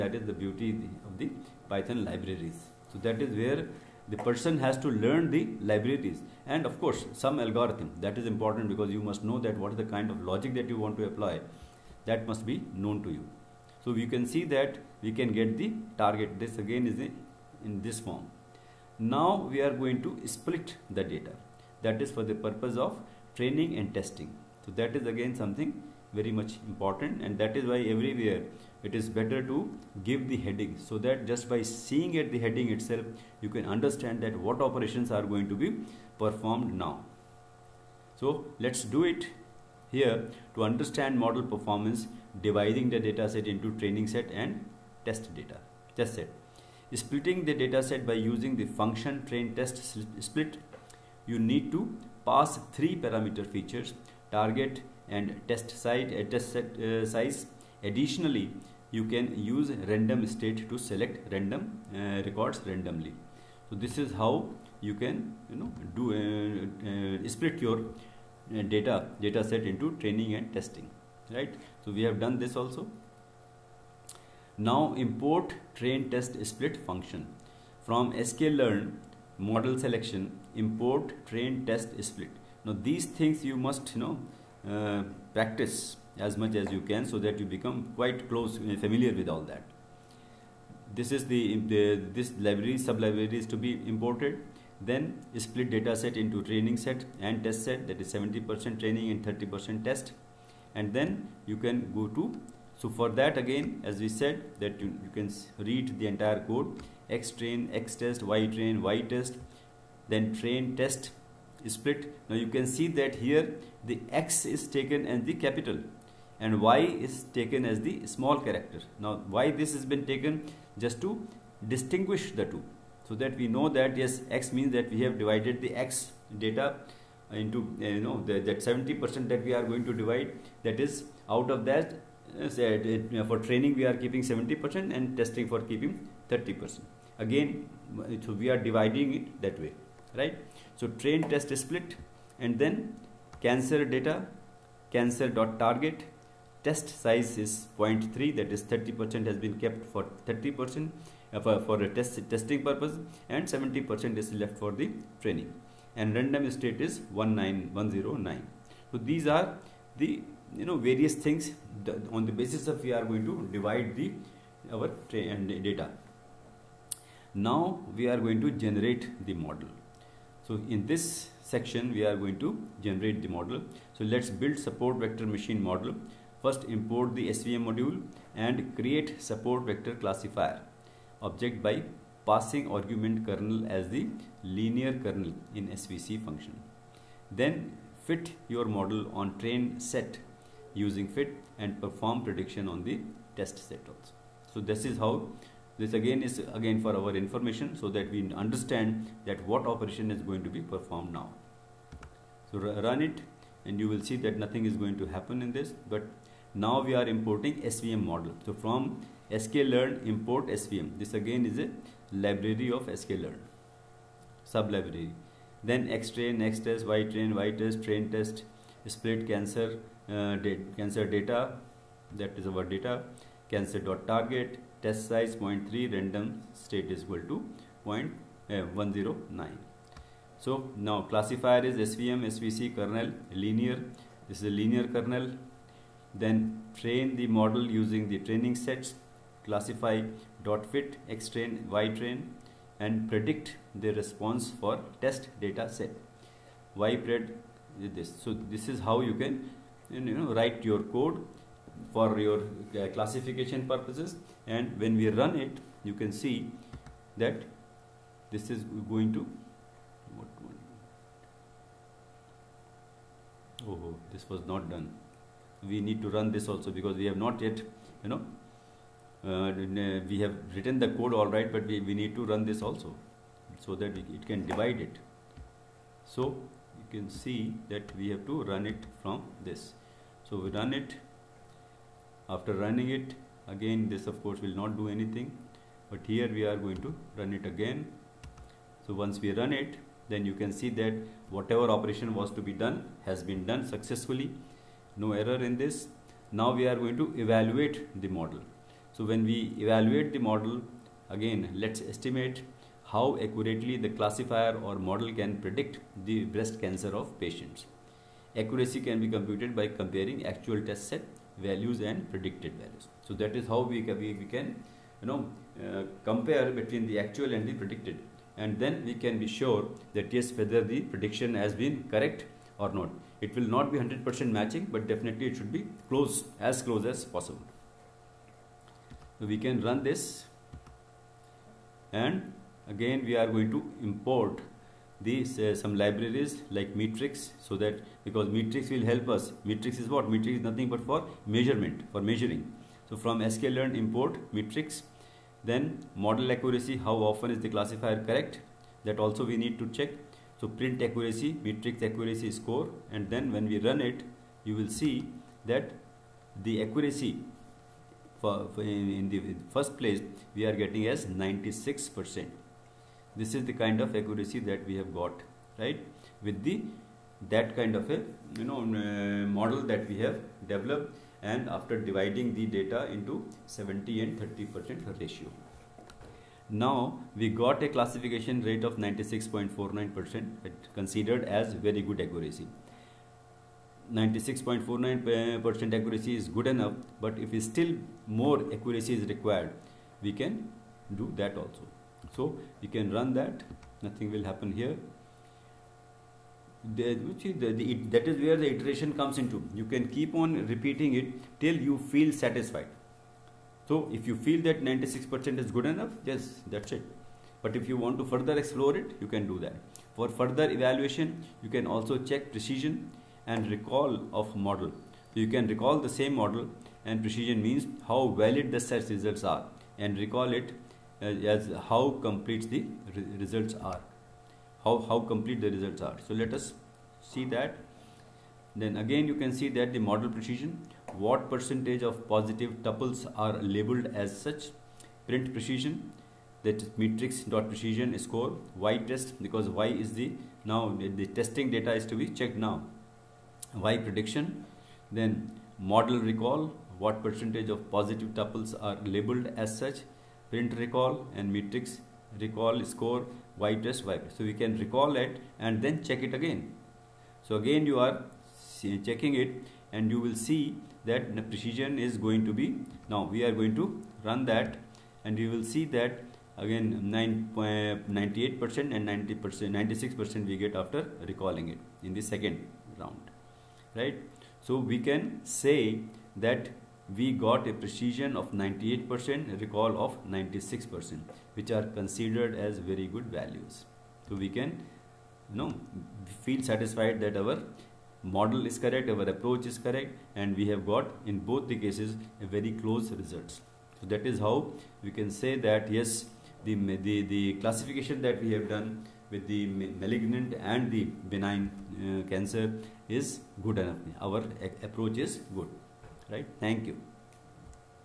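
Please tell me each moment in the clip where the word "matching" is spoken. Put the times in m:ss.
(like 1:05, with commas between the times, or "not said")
5:24.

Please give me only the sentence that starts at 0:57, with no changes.
Additionally, you can use random state to select random uh, records randomly.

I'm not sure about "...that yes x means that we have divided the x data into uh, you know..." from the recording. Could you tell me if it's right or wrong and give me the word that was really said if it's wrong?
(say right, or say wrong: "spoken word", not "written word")
right.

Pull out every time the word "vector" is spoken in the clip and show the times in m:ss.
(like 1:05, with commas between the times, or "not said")
2:54, 2:59.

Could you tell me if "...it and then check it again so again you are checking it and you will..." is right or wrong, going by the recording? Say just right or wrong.
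right.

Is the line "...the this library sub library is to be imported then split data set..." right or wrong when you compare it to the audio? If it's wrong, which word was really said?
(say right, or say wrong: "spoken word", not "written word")
right.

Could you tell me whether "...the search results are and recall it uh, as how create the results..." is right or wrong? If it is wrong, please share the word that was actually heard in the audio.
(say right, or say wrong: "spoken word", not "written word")
wrong: "complete", not "create".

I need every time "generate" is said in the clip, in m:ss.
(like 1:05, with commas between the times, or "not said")
2:48, 2:52.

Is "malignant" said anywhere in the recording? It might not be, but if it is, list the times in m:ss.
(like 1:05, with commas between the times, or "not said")
8:19.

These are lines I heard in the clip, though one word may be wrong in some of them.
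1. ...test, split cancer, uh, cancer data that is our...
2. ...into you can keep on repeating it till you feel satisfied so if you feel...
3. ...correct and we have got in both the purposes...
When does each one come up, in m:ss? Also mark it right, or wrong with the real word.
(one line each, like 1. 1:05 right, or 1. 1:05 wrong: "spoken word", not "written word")
1. 3:38 right
2. 6:39 right
3. 8:09 wrong: "cases", not "purposes".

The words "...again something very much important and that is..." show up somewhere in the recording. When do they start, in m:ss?
0:25.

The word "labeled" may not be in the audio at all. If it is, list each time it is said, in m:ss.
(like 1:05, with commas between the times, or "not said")
7:13, 7:28.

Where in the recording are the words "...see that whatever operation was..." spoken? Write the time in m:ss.
4:50.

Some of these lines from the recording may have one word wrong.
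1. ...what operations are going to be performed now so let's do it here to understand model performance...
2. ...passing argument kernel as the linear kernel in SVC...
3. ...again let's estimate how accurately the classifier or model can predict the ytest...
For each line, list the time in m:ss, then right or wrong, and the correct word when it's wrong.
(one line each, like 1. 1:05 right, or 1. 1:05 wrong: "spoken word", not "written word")
1. 0:34 right
2. 3:02 right
3. 5:01 wrong: "breast", not "ytest".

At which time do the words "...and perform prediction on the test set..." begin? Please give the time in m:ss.
3:11.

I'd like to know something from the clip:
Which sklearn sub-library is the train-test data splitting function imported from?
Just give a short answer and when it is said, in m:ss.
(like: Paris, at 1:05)
model selection, at 1:18.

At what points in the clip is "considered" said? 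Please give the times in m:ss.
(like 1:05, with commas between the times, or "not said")
6:20, 8:01.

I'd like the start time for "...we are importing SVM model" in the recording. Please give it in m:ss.
3:26.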